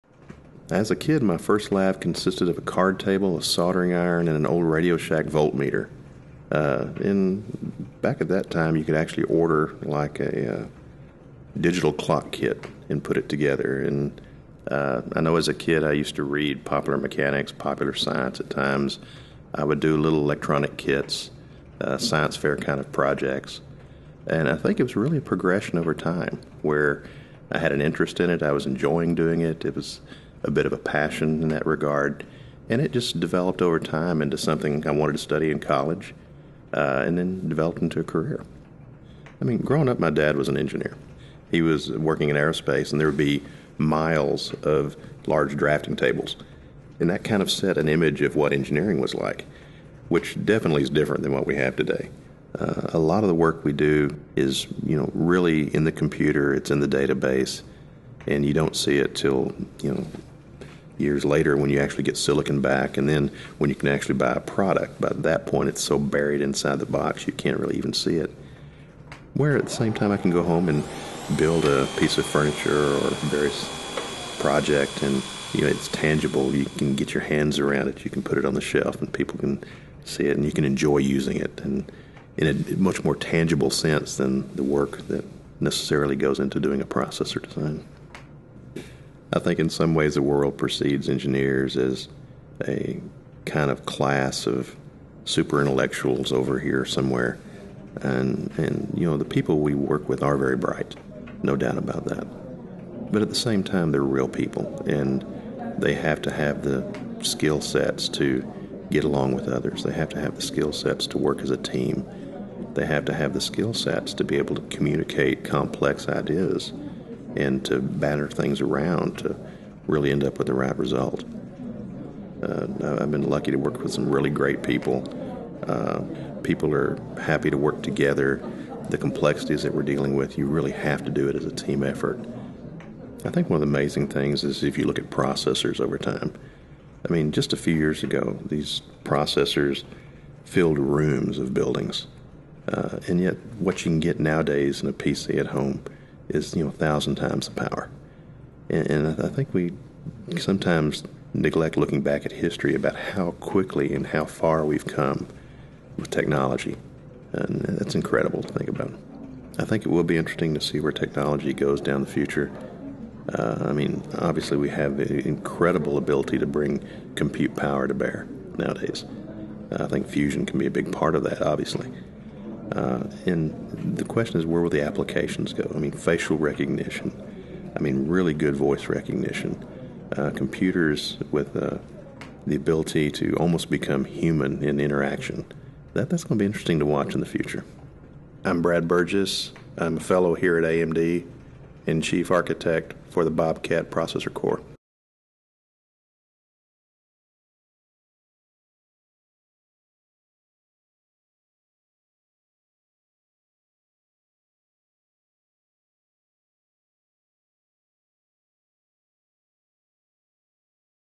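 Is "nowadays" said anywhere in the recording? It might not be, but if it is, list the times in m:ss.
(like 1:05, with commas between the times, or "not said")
2:24, 2:48.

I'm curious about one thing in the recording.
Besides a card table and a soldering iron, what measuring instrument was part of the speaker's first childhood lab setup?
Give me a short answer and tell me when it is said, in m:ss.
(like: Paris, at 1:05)
Radio Shack voltmeter, at 0:04.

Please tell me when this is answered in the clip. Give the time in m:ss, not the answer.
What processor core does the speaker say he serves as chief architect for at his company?
3:13.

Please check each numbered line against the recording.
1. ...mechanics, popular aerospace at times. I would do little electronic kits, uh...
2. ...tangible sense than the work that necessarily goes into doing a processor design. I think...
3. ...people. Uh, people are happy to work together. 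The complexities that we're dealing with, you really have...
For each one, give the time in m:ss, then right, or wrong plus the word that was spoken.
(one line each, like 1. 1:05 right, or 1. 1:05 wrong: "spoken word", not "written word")
1. 0:16 wrong: "science", not "aerospace"
2. 1:23 right
3. 2:04 right.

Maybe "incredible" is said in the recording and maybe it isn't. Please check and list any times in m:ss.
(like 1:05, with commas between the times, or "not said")
2:37, 2:44.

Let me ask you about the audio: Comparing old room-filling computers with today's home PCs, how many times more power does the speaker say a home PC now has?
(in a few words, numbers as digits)
1000.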